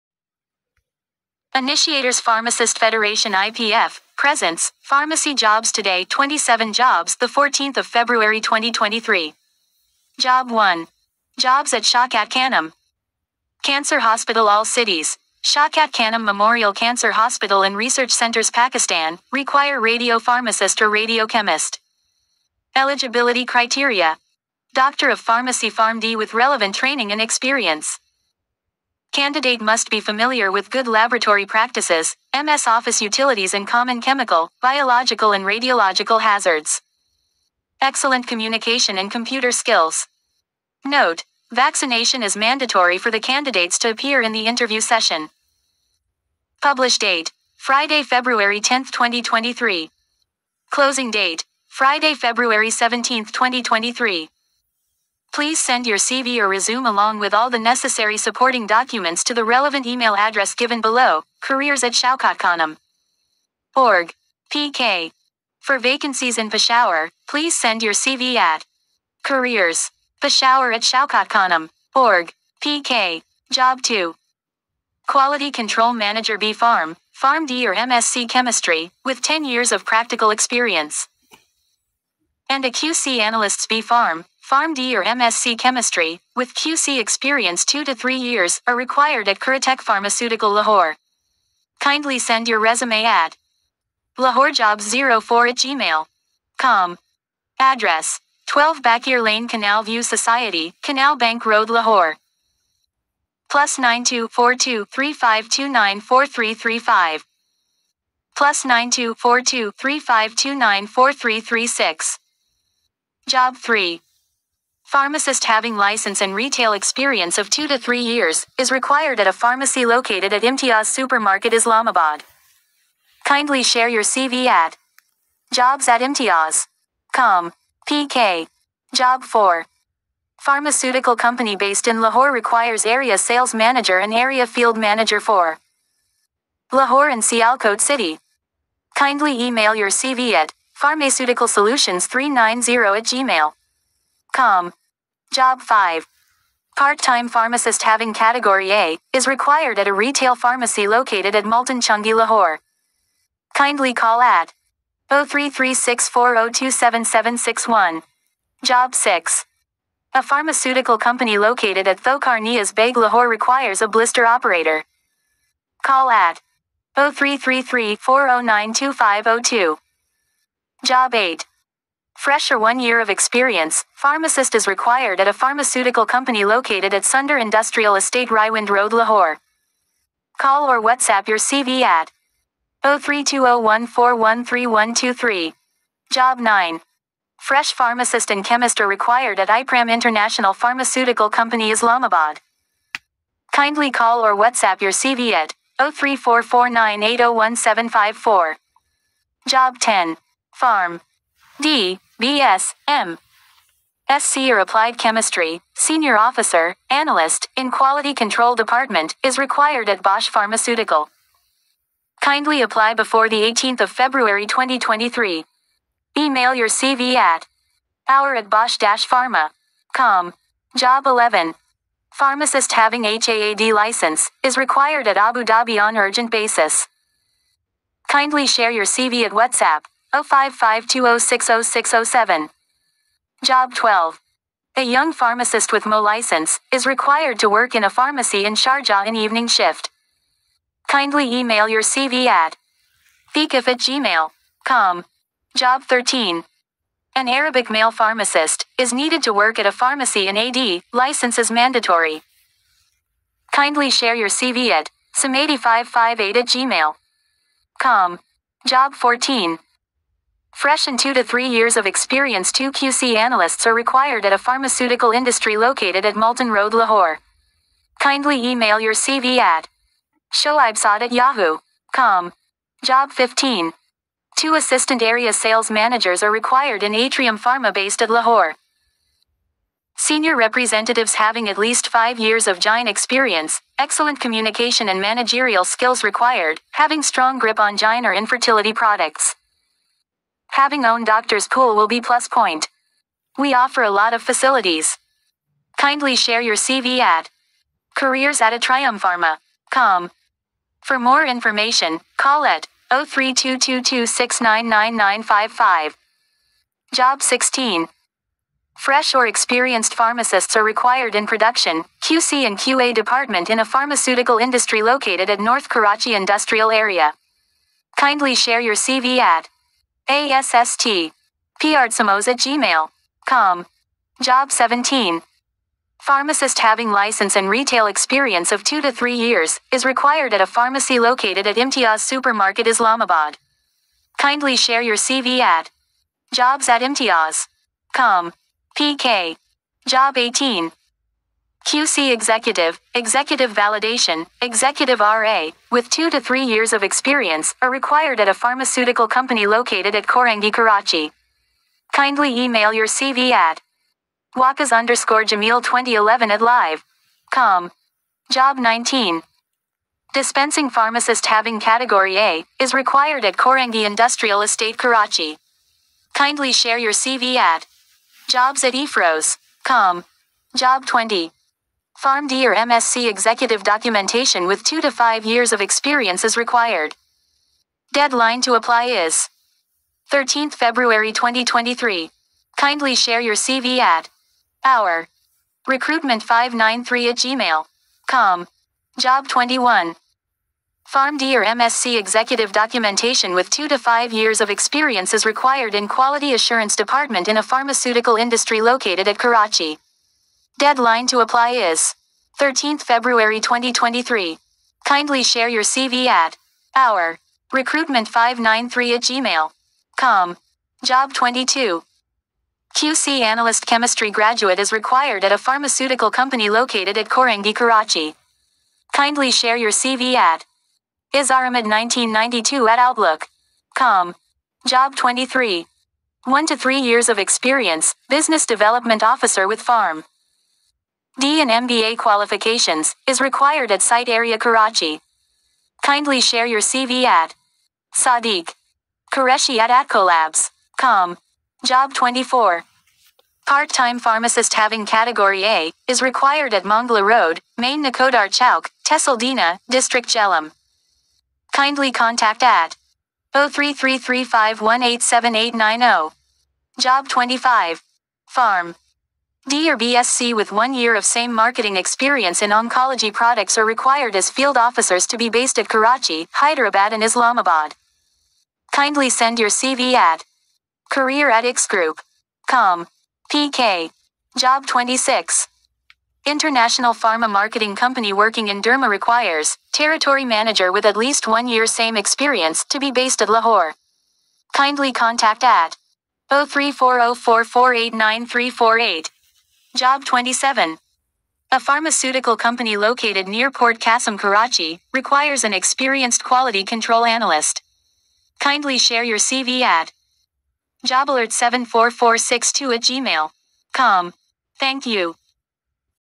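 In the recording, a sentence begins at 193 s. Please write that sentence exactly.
Kindly call or WhatsApp your CV at 0344980174.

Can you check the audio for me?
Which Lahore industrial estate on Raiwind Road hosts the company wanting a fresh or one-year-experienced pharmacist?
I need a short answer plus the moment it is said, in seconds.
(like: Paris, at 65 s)
Sunder Industrial Estate, at 177 s.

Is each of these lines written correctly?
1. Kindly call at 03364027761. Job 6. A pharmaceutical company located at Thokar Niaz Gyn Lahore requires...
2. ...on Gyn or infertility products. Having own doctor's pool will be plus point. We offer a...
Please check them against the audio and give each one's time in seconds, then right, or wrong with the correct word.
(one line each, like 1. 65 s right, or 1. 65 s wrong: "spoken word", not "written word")
1. 153 s wrong: "Baig", not "Gyn"
2. 287 s right.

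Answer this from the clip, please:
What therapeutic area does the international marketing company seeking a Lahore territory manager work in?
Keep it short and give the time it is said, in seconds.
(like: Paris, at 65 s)
Derma, at 478 s.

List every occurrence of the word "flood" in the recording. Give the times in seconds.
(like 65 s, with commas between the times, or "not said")
not said.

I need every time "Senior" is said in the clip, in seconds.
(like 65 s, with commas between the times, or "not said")
205 s, 279 s.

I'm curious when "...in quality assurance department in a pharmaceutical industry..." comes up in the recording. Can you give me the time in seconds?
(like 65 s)
395 s.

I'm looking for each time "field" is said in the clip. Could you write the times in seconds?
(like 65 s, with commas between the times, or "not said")
134 s, 464 s.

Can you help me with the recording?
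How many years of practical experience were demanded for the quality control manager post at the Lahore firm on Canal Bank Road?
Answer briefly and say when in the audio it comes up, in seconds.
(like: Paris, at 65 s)
10, at 79 s.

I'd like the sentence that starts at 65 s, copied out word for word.
For vacancies in Peshawar, please send your CV at careers.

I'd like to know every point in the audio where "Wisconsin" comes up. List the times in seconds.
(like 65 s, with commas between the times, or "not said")
not said.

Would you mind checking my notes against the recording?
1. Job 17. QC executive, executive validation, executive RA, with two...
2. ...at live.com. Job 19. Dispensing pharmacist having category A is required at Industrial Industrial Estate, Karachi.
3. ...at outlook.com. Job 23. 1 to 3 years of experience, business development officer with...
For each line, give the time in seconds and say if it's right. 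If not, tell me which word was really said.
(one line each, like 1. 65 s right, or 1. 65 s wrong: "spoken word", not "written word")
1. 339 s wrong: "18", not "17"
2. 356 s wrong: "Korangi", not "Industrial"
3. 422 s right.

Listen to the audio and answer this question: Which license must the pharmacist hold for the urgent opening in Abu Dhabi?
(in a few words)
HAAD.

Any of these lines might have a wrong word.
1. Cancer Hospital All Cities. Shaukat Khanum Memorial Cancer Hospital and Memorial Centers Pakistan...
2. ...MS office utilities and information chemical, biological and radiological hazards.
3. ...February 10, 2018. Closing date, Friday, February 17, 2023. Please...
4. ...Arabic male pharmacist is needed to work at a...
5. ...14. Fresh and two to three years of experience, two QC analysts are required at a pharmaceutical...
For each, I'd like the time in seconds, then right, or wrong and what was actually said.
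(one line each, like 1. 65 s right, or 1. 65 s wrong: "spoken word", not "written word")
1. 13 s wrong: "Research", not "Memorial"
2. 32 s wrong: "common", not "information"
3. 48 s wrong: "2023", not "2018"
4. 247 s right
5. 258 s right.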